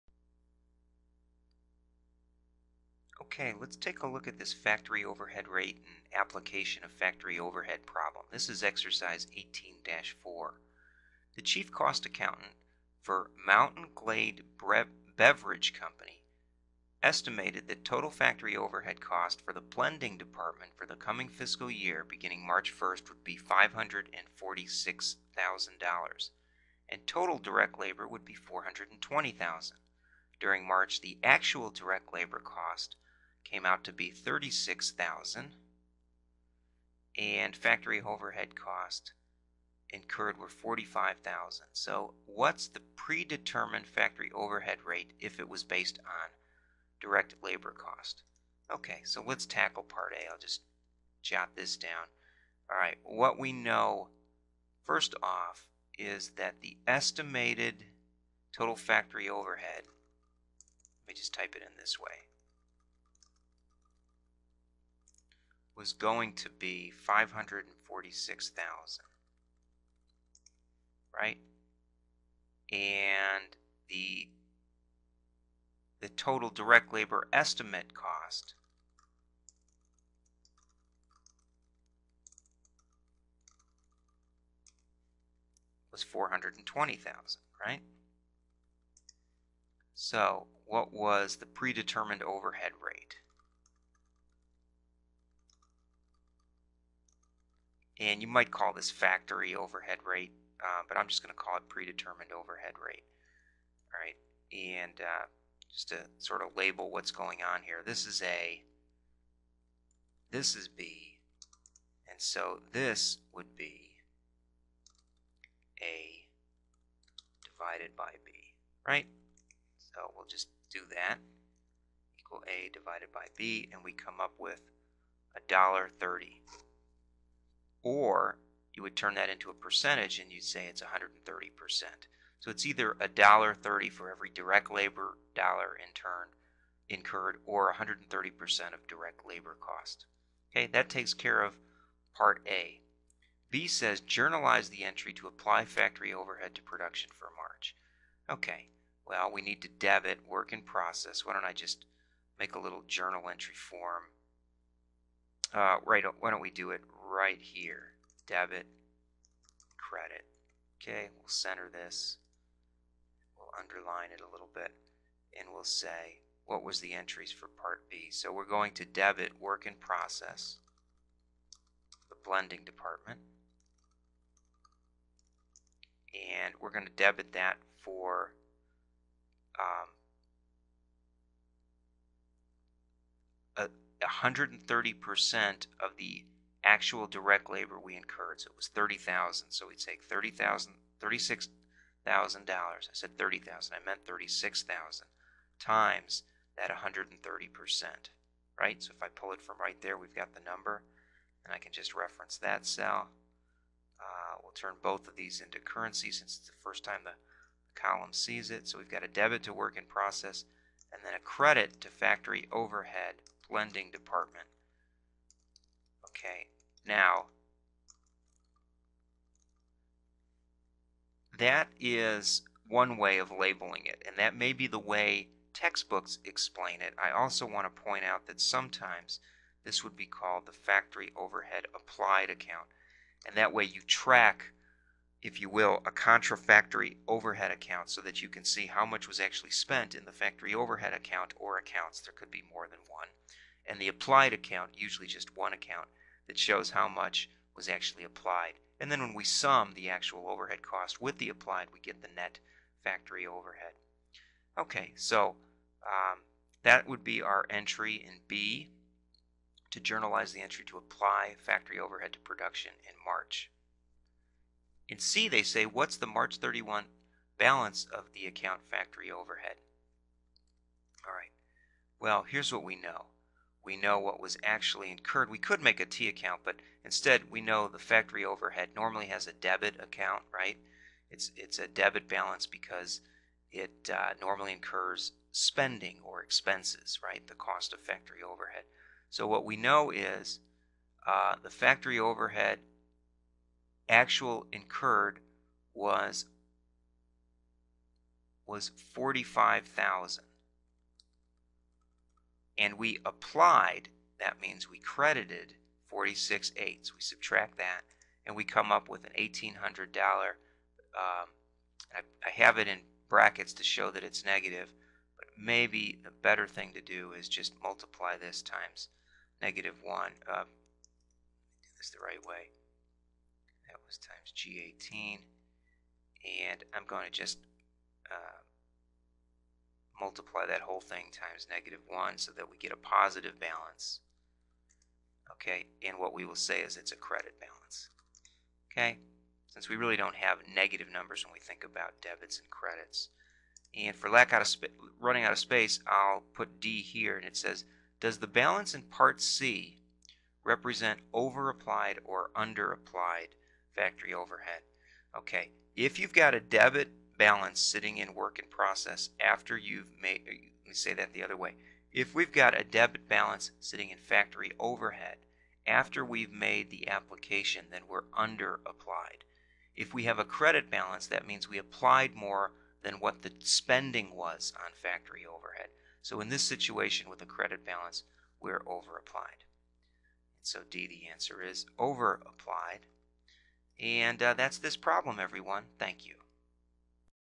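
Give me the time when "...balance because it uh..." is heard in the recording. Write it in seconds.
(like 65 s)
282 s.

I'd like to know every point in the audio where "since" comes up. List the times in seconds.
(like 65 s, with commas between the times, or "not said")
206 s, 339 s.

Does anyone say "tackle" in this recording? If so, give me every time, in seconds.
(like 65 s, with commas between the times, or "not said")
49 s.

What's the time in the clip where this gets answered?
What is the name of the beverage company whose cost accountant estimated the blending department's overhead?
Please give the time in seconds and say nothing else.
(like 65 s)
13 s.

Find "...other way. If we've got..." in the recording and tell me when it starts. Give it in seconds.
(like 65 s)
361 s.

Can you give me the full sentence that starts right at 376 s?
So in this situation with a credit balance, we're over applied.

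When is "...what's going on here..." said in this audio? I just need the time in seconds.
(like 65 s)
106 s.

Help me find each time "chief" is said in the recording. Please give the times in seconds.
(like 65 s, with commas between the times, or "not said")
11 s.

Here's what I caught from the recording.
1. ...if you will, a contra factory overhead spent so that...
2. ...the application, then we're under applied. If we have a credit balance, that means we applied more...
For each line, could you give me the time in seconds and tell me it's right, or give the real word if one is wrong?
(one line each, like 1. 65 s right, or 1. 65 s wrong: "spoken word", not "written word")
1. 235 s wrong: "account", not "spent"
2. 366 s right.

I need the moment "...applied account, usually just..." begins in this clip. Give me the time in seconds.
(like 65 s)
243 s.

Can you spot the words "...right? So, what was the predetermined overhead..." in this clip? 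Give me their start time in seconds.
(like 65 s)
87 s.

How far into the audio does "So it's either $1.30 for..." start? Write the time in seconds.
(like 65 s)
132 s.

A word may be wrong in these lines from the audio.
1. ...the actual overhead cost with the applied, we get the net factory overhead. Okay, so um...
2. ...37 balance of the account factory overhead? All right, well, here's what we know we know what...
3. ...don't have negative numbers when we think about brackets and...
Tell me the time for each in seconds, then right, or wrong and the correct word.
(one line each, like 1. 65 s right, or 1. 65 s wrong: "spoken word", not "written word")
1. 249 s right
2. 266 s wrong: "31", not "37"
3. 339 s wrong: "debits", not "brackets".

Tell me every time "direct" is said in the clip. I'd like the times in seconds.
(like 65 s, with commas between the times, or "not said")
27 s, 31 s, 47 s, 76 s, 134 s, 138 s, 187 s.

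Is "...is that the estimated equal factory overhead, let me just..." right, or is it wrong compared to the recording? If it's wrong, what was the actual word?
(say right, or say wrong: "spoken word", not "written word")
wrong: "total", not "equal".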